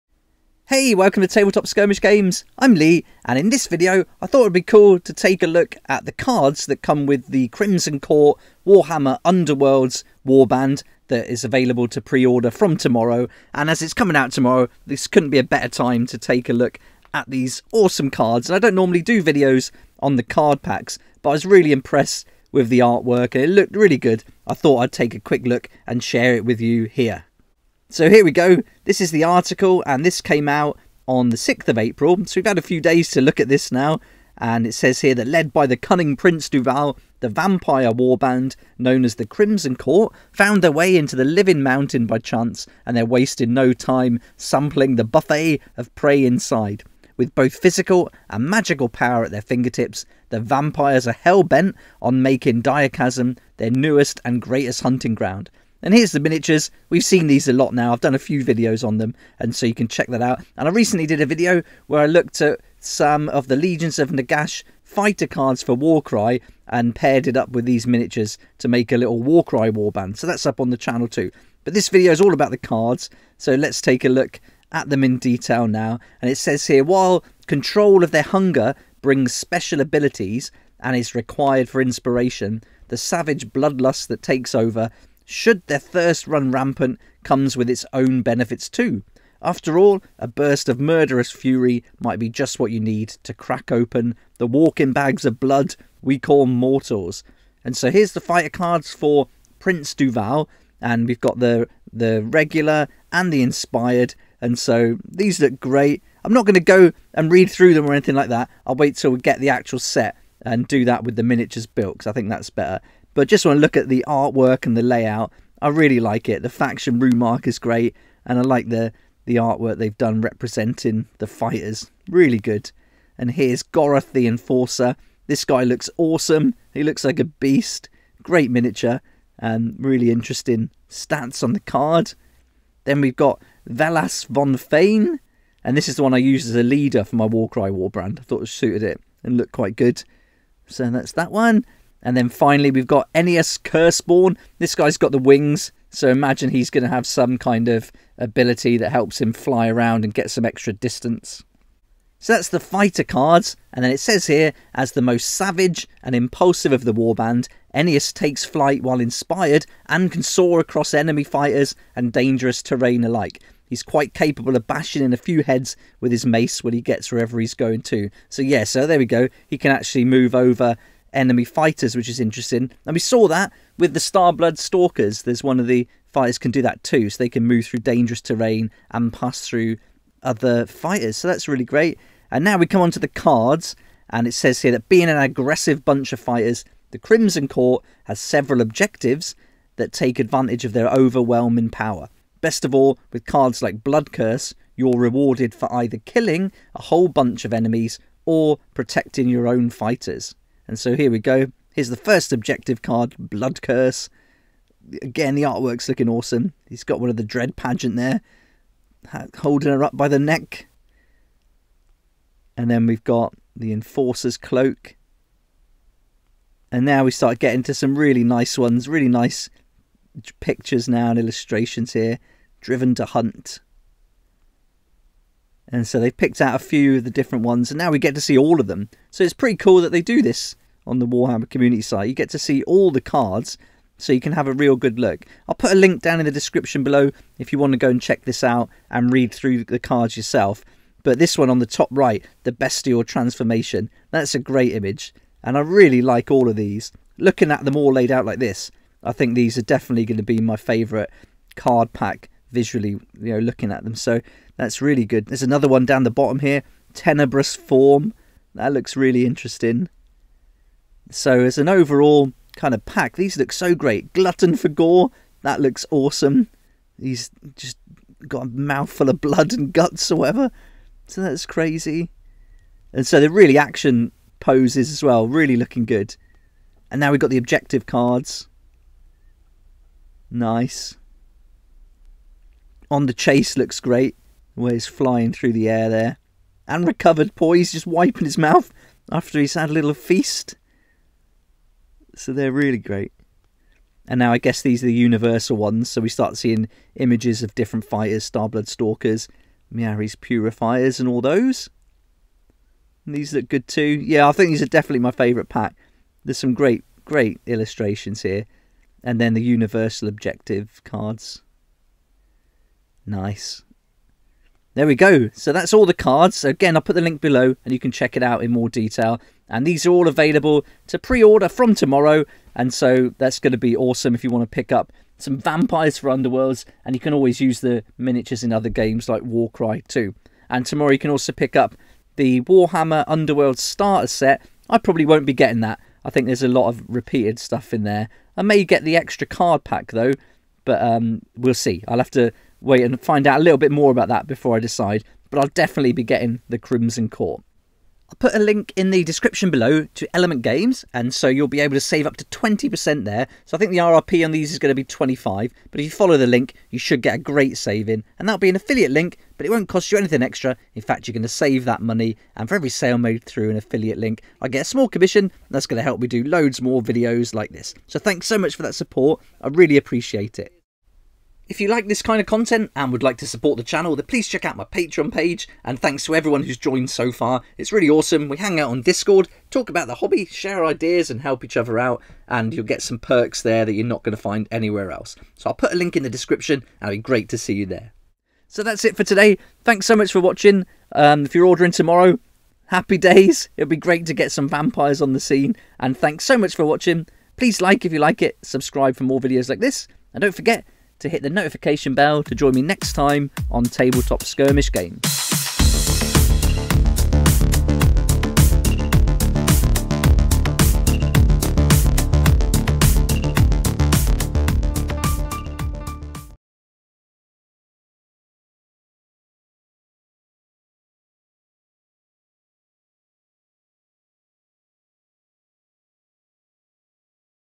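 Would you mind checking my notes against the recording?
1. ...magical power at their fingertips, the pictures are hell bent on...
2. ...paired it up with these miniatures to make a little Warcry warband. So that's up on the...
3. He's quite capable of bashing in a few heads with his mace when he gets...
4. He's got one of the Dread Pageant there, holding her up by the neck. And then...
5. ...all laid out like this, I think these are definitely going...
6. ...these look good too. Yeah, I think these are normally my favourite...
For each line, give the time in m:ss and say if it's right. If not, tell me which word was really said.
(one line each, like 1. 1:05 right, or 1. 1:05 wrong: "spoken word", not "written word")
1. 0:48 wrong: "vampires", not "pictures"
2. 1:06 right
3. 2:43 right
4. 3:26 right
5. 4:07 right
6. 5:03 wrong: "definitely", not "normally".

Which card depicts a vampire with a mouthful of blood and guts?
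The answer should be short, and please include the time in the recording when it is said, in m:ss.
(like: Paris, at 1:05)
Glutton for Gore, at 4:24.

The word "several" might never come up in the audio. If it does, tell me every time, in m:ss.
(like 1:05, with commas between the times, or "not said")
3:08.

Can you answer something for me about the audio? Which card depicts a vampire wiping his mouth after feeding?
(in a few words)
Recovered Poise.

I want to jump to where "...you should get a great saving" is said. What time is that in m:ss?
5:56.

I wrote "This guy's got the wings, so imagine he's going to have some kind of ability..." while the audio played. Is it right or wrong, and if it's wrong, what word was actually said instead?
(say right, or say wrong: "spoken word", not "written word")
right.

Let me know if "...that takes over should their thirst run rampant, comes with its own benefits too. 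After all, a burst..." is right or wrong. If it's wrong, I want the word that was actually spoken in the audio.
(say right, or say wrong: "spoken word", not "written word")
right.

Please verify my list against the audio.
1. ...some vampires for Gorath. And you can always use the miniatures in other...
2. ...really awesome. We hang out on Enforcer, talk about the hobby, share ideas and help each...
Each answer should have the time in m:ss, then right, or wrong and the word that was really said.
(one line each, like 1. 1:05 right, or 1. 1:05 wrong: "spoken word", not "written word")
1. 5:25 wrong: "Underworlds", not "Gorath"
2. 6:17 wrong: "Discord", not "Enforcer".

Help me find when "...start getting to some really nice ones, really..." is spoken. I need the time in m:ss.
3:37.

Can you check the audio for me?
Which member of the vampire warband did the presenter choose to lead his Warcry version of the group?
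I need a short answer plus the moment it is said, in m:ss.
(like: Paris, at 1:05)
Vellas von Faine, at 2:13.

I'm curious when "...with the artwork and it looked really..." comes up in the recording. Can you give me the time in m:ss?
0:22.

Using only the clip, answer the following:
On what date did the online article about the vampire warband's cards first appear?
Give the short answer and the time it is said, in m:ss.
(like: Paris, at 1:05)
6th of April, at 0:31.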